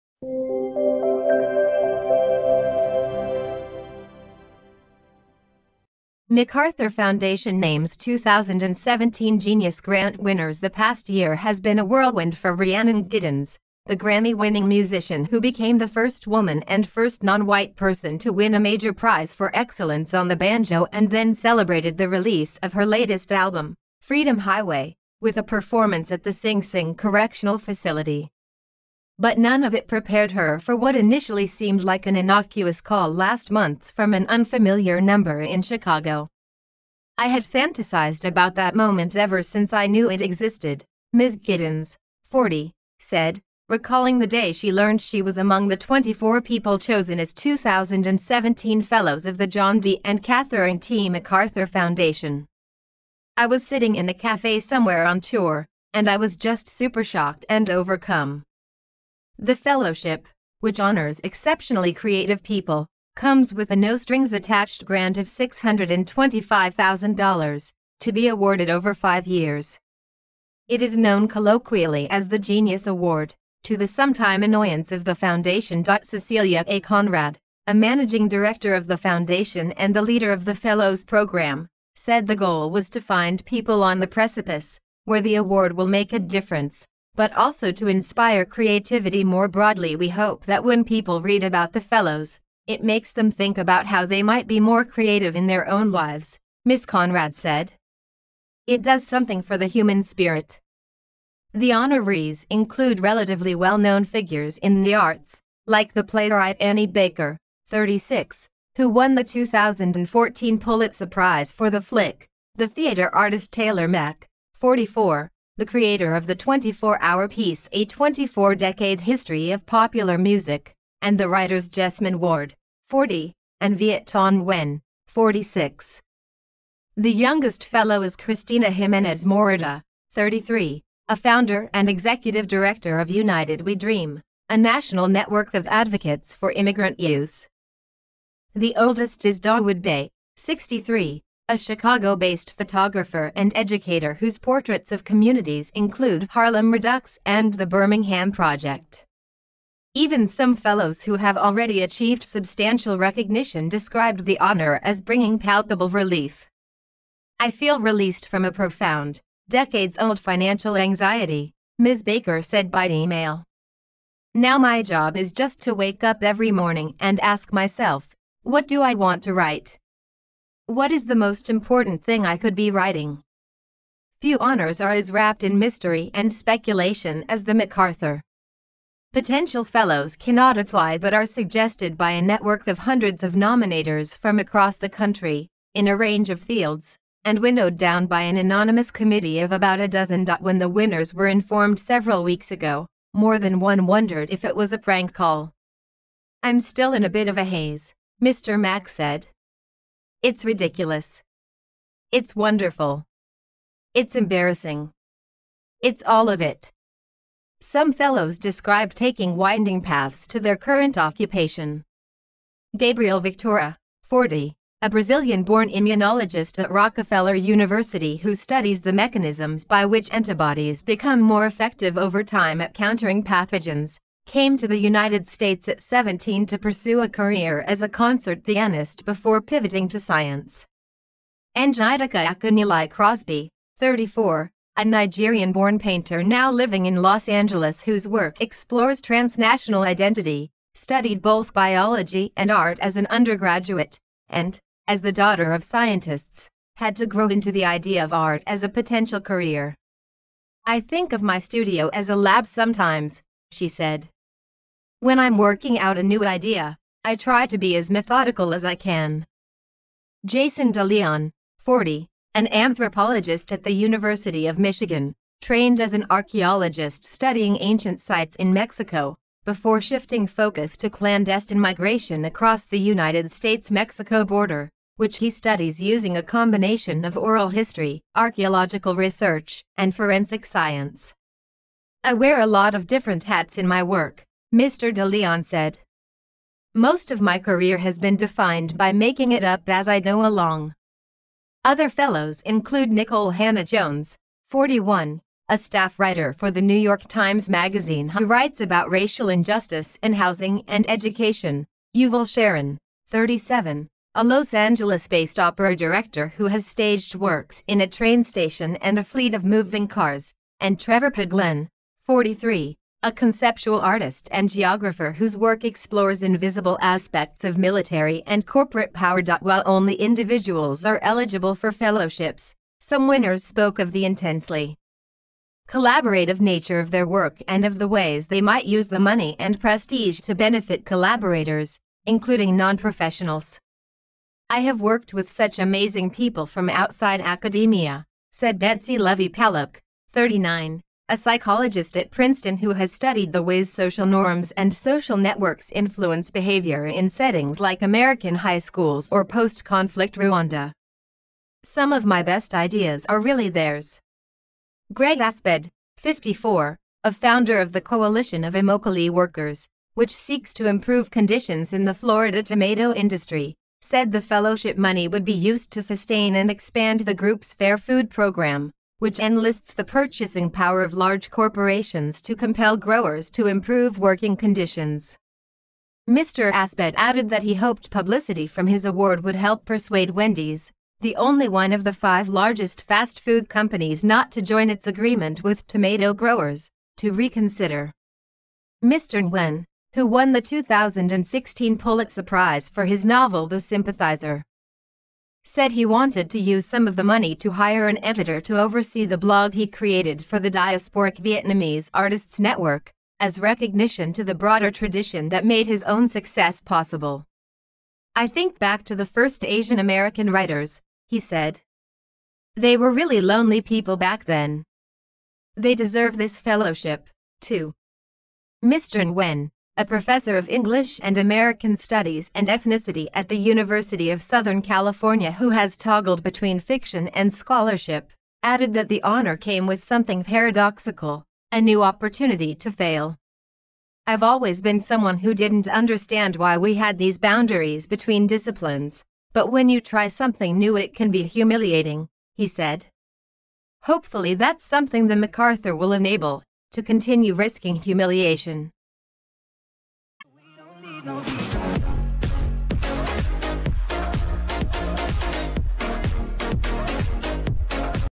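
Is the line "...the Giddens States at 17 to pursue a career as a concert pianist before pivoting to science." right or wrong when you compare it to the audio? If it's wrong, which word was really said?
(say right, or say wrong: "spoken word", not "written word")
wrong: "United", not "Giddens".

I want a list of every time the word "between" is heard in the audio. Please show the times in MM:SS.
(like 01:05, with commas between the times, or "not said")
07:06, 07:17.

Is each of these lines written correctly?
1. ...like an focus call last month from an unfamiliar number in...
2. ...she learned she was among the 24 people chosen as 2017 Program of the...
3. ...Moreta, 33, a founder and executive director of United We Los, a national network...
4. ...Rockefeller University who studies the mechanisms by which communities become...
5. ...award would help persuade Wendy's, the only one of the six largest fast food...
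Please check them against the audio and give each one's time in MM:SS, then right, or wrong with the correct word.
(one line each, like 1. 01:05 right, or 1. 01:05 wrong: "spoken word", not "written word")
1. 00:31 wrong: "innocuous", not "focus"
2. 00:44 wrong: "Fellows", not "Program"
3. 02:09 wrong: "Dream", not "Los"
4. 03:36 wrong: "antibodies", not "communities"
5. 06:18 wrong: "five", not "six".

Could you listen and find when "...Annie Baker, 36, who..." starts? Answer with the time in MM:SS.
01:46.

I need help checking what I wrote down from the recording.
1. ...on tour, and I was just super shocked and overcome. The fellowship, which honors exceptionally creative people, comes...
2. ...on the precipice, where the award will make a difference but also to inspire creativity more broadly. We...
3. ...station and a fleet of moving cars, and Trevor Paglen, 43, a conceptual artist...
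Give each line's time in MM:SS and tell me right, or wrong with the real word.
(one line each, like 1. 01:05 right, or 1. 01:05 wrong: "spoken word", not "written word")
1. 00:55 right
2. 01:23 right
3. 05:08 right.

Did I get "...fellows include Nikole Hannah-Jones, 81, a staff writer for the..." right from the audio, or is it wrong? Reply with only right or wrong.
wrong.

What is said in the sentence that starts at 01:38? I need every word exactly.
It does something for the human spirit.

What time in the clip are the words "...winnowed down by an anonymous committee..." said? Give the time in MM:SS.
03:07.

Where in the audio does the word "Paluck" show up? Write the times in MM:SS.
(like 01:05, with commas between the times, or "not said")
05:39.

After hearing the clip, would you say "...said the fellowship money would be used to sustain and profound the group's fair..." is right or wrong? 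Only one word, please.
wrong.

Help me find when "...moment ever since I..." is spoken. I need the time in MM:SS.
00:38.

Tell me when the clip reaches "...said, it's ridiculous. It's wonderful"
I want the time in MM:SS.
03:18.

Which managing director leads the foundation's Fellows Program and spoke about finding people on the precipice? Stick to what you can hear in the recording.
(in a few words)
Cecilia A. Conrad.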